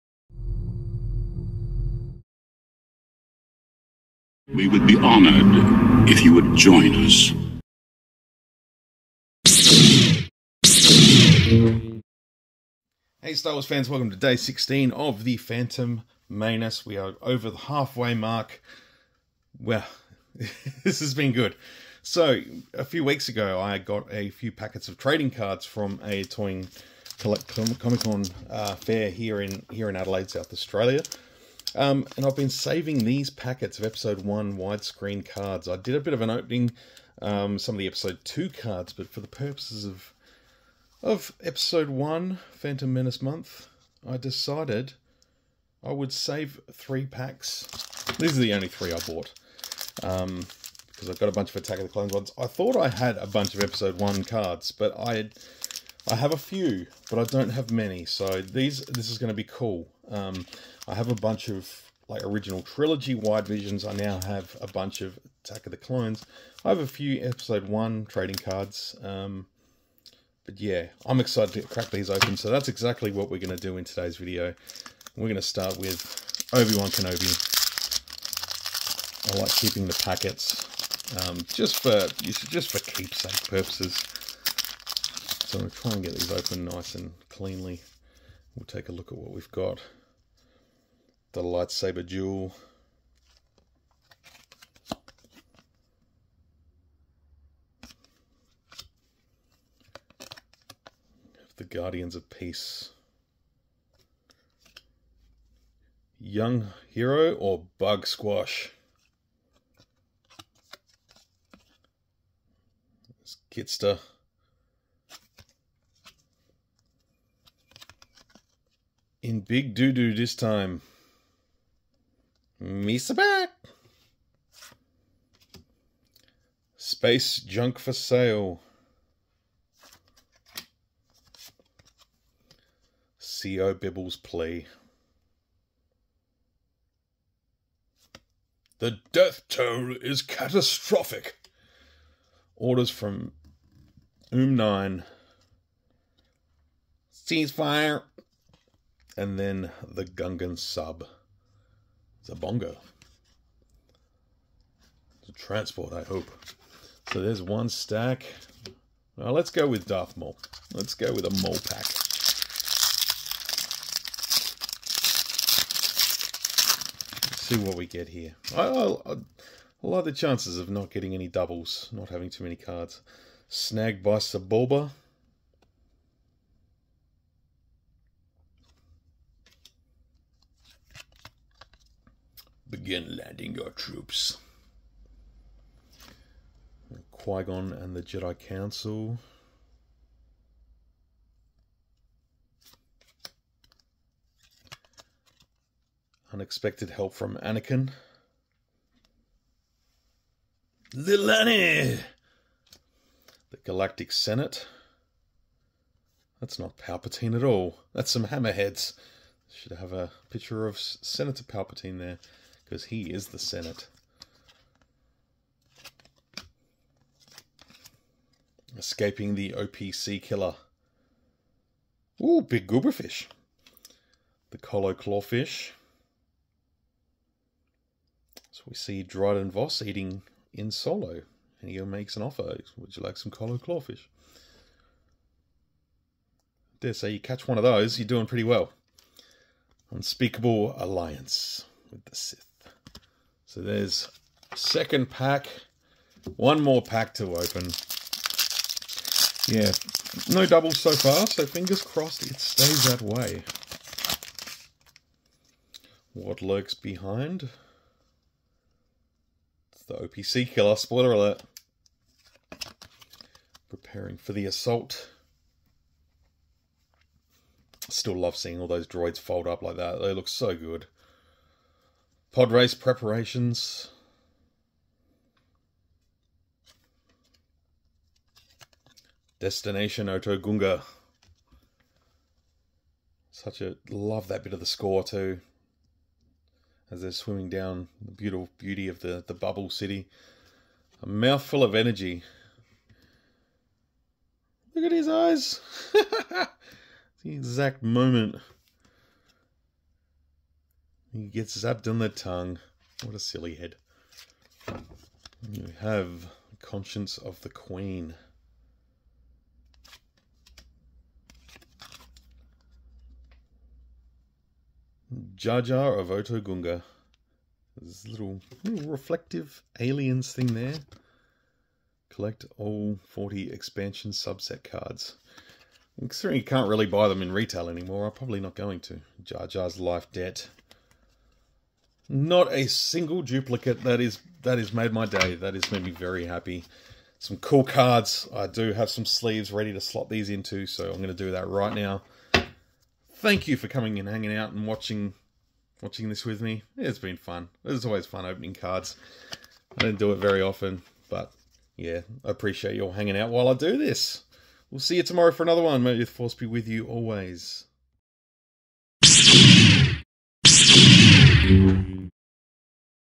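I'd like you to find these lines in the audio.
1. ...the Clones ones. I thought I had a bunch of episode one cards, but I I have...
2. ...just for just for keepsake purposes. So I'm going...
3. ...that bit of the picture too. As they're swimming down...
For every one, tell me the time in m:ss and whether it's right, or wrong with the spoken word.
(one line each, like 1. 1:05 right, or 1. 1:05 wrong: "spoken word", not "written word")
1. 0:51 right
2. 1:21 right
3. 4:44 wrong: "score", not "picture".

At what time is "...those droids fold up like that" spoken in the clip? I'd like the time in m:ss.
4:28.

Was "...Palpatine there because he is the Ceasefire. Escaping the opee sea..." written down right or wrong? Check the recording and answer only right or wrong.
wrong.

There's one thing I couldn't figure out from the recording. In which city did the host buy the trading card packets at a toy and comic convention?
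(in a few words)
Adelaide.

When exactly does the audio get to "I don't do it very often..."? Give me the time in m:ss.
5:49.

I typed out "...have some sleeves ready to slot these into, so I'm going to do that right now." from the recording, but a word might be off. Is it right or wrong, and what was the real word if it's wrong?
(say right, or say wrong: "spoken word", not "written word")
right.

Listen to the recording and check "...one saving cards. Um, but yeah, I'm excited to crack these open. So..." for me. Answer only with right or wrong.
wrong.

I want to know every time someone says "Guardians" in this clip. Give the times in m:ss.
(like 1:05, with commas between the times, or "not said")
1:41.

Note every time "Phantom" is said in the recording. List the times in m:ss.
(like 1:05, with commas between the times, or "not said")
0:15, 0:42.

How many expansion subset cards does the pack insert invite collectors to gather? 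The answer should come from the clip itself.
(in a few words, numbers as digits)
40.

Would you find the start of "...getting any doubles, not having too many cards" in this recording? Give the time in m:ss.
2:50.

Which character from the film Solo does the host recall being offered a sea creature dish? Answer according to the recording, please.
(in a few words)
Dryden Voss.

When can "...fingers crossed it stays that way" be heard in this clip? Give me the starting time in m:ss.
4:11.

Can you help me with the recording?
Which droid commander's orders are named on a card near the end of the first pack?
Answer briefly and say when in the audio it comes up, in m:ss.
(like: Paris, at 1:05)
Oom 9, at 2:24.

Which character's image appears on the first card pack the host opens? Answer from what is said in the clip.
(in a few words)
Obi-Wan Kenobi.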